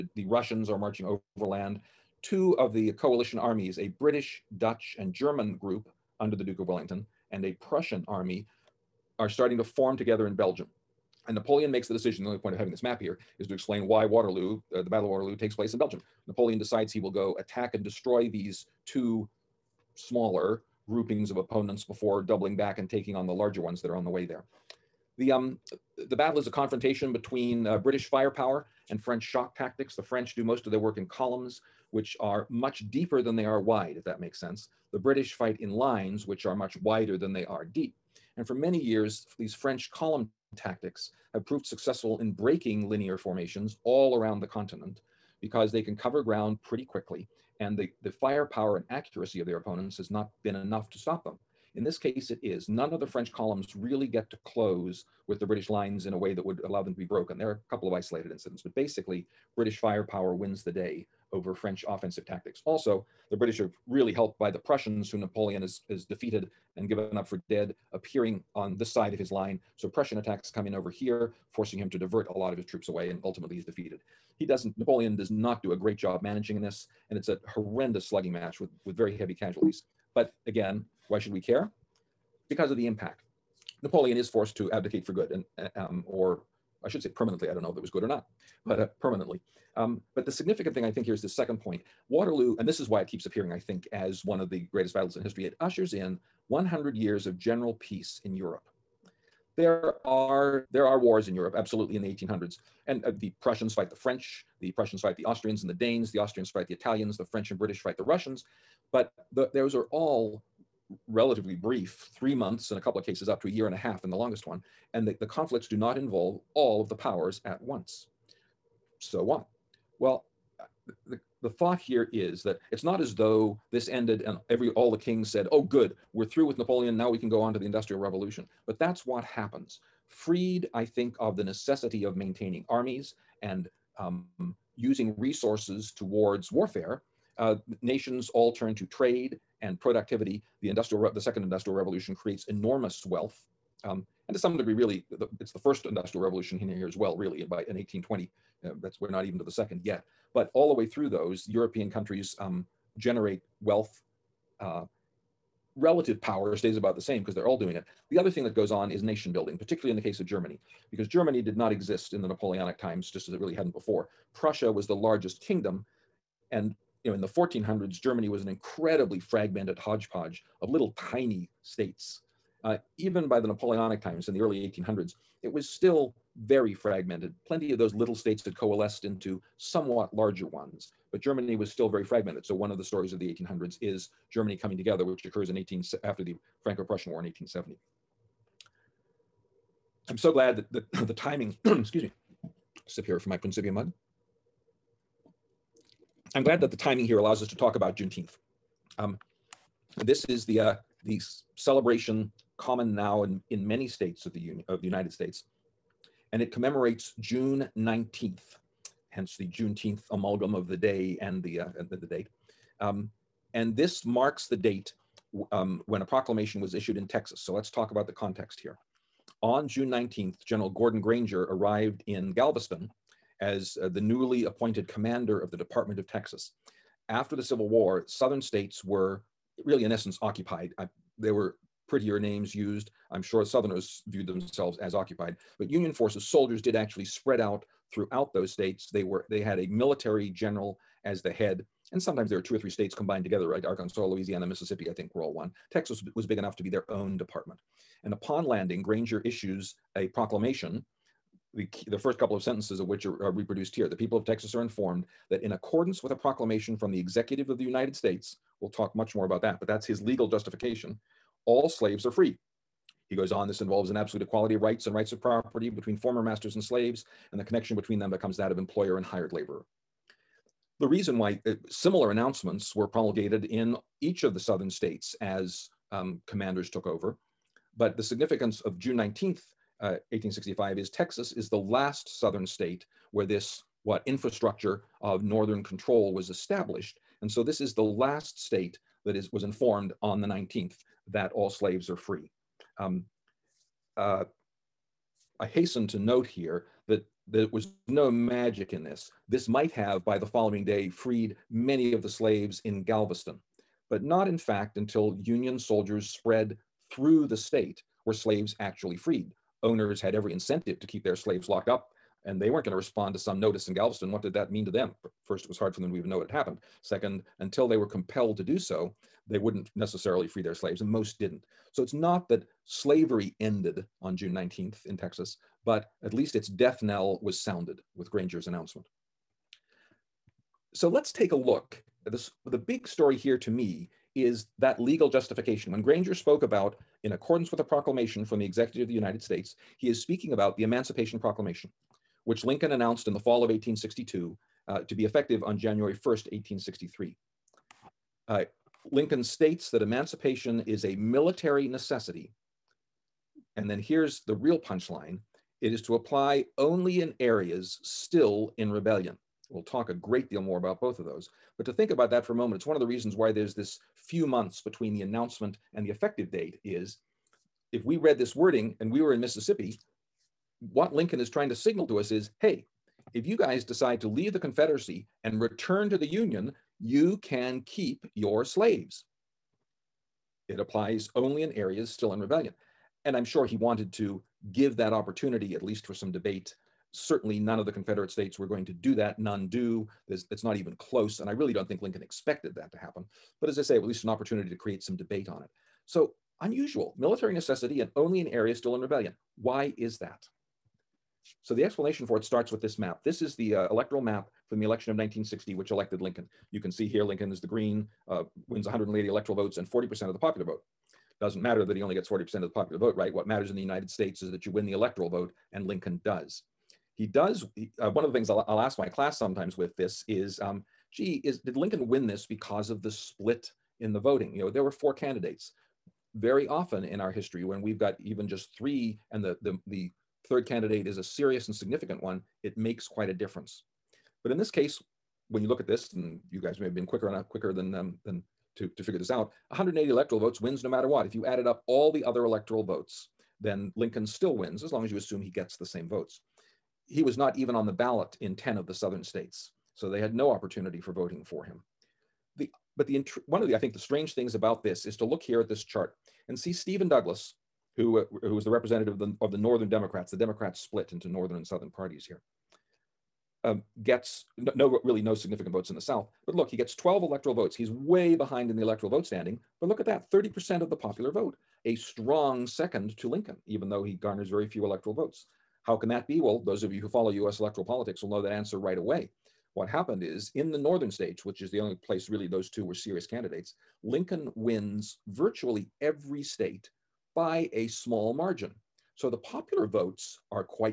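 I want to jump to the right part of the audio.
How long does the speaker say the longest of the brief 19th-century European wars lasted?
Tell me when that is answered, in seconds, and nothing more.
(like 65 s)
113 s.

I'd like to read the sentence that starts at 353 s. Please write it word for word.
And then here's the real punchline it is to apply only in areas still in rebellion.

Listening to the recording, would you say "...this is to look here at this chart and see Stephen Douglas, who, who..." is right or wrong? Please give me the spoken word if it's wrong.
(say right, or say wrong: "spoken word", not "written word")
right.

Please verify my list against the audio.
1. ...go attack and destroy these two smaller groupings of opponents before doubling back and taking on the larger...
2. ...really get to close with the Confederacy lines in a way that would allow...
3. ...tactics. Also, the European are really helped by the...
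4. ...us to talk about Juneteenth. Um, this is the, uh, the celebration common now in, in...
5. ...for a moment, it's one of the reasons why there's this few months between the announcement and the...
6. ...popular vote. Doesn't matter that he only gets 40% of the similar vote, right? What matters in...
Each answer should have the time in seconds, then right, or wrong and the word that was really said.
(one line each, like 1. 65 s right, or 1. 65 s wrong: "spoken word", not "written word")
1. 17 s right
2. 53 s wrong: "British", not "Confederacy"
3. 62 s wrong: "British", not "European"
4. 197 s right
5. 362 s right
6. 410 s wrong: "popular", not "similar".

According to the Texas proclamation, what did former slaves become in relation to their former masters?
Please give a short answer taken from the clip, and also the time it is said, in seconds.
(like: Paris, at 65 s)
Hired laborer, at 269 s.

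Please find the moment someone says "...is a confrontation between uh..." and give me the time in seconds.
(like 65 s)
26 s.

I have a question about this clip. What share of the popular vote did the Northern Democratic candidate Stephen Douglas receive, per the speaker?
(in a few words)
30%.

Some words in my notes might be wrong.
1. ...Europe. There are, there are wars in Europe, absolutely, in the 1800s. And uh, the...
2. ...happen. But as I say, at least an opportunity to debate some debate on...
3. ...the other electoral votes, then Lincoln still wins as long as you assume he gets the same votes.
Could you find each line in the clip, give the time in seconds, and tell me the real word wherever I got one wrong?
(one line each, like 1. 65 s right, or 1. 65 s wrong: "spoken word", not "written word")
1. 98 s right
2. 392 s wrong: "create", not "debate"
3. 441 s right.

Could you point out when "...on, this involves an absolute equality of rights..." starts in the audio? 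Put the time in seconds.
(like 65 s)
263 s.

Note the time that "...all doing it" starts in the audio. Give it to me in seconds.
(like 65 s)
157 s.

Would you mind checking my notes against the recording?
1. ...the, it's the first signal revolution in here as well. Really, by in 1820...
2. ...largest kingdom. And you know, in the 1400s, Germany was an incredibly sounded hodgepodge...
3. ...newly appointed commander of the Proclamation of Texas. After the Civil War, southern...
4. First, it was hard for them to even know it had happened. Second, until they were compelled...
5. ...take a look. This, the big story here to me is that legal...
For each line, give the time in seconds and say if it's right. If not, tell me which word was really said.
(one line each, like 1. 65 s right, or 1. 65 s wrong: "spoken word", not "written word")
1. 145 s wrong: "industrial", not "signal"
2. 164 s wrong: "fragmented", not "sounded"
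3. 224 s wrong: "Department", not "Proclamation"
4. 315 s right
5. 331 s right.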